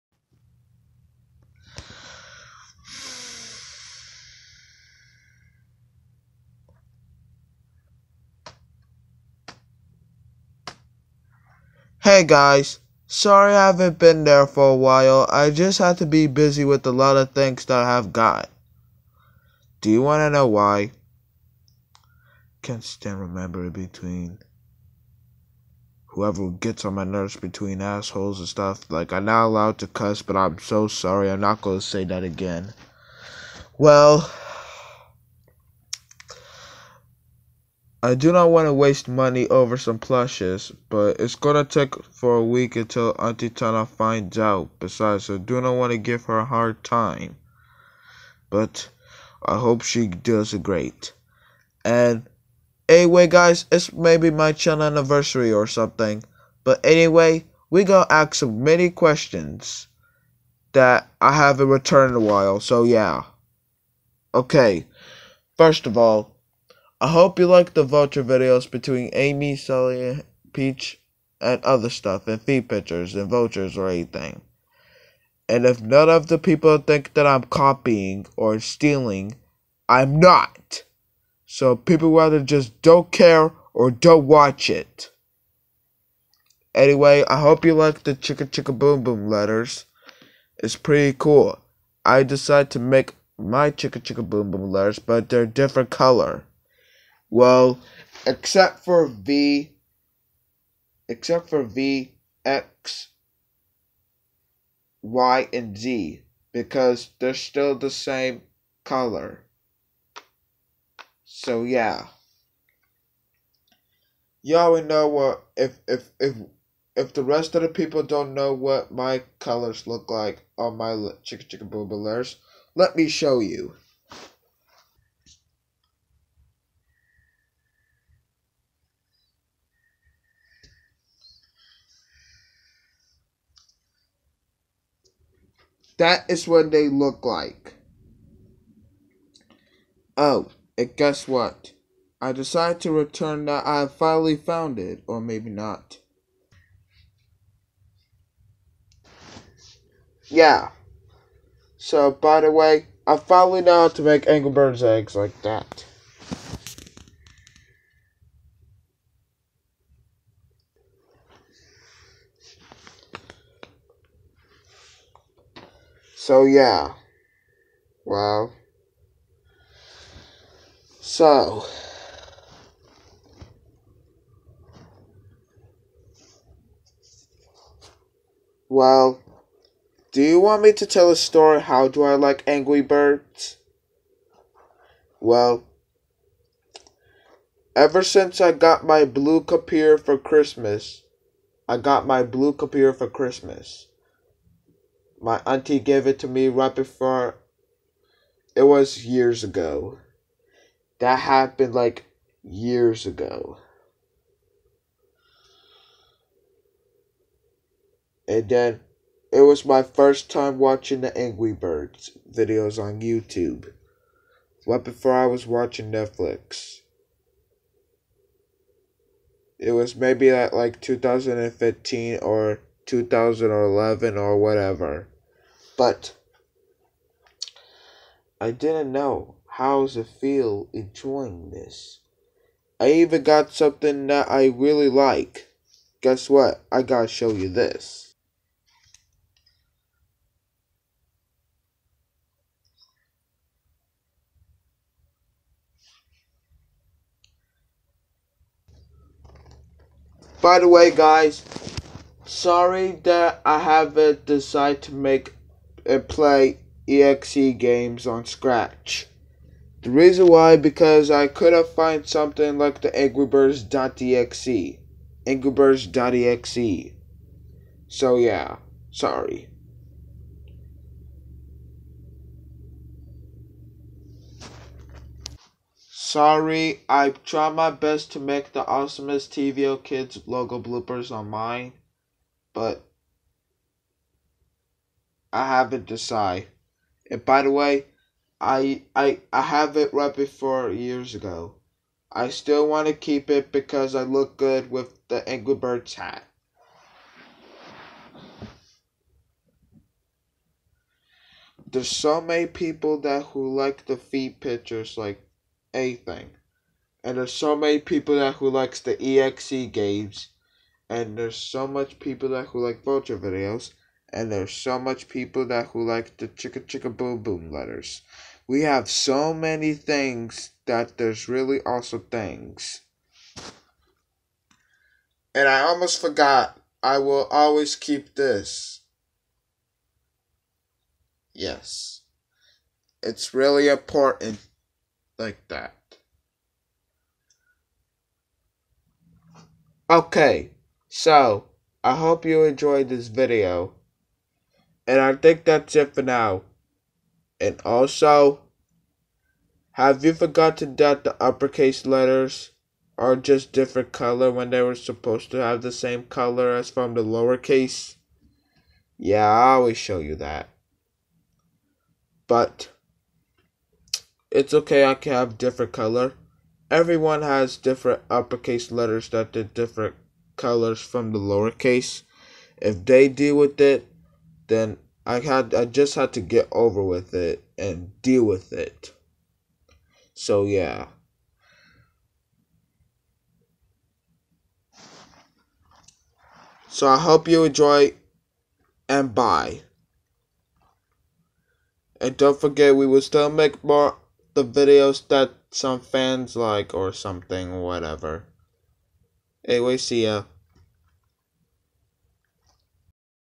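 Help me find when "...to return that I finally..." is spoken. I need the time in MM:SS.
02:22.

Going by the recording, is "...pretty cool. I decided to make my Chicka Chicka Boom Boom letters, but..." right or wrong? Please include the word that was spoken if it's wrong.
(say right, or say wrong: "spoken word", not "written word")
right.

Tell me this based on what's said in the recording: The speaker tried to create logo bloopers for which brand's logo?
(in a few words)
TVO Kids.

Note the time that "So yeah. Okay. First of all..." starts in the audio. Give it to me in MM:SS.
01:02.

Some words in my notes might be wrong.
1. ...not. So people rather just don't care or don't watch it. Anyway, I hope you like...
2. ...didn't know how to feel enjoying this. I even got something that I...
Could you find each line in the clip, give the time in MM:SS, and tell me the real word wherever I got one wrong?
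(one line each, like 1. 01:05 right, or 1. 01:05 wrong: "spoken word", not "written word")
1. 01:20 right
2. 03:48 right.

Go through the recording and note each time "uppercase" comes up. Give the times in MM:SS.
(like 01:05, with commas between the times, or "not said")
05:51, 06:08.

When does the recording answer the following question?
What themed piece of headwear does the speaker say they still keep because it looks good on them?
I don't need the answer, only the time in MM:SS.
04:55.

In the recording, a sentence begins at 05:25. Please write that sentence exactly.
And I almost forgot, I will always keep this.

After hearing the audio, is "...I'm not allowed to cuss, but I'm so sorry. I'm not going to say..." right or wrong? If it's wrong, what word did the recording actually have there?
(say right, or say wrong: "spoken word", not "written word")
right.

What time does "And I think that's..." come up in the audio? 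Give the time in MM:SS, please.
05:44.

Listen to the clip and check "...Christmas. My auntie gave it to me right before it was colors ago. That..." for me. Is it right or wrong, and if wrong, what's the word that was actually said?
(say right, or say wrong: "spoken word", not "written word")
wrong: "years", not "colors".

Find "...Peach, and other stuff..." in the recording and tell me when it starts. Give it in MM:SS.
01:10.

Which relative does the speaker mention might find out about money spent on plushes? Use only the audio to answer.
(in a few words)
Auntie Tana.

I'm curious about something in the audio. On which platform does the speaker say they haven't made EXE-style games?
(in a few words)
Scratch.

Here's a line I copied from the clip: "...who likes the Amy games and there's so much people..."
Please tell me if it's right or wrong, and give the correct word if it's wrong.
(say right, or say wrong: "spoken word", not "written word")
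wrong: "EXE", not "Amy".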